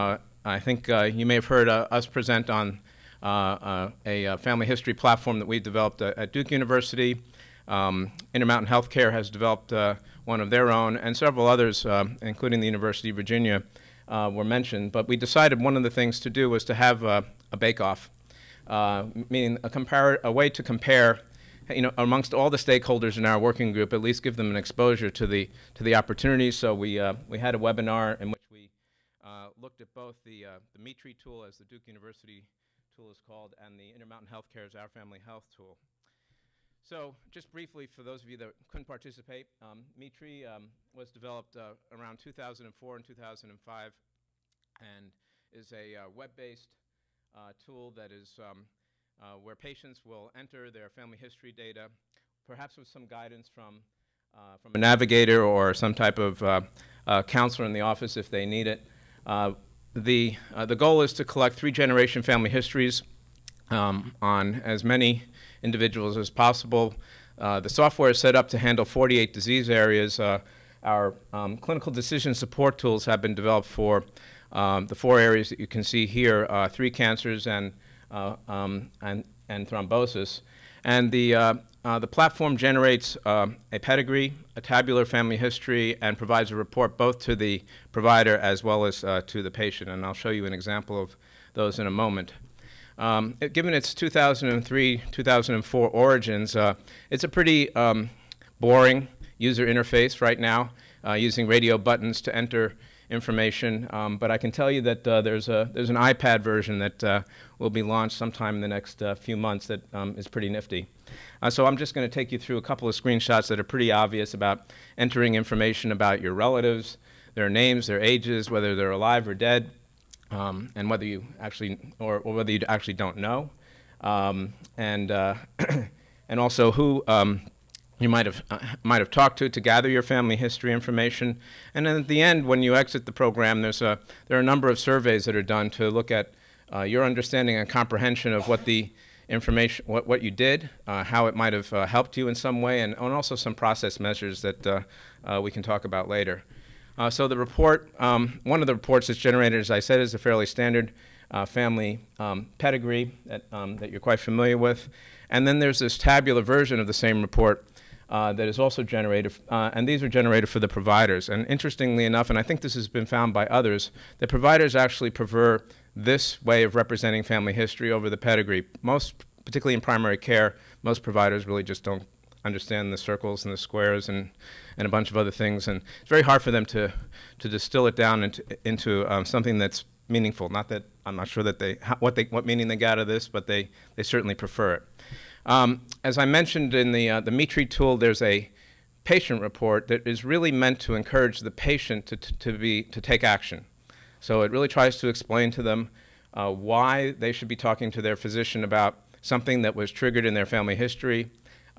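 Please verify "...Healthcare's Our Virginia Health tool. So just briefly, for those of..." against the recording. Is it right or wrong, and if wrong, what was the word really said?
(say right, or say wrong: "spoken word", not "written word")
wrong: "Family", not "Virginia".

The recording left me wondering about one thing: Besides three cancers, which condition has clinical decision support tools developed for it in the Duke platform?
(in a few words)
Thrombosis.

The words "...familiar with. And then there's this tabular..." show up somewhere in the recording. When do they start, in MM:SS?
02:34.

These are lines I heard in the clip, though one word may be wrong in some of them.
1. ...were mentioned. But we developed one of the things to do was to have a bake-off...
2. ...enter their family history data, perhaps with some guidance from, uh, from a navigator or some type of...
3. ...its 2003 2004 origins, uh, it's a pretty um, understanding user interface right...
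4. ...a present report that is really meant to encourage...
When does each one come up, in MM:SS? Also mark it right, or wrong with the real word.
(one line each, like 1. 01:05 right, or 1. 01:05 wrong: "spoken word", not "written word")
1. 00:14 wrong: "decided", not "developed"
2. 00:50 right
3. 01:33 wrong: "boring", not "understanding"
4. 03:08 wrong: "patient", not "present".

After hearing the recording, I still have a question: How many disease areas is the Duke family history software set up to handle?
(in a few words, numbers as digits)
48.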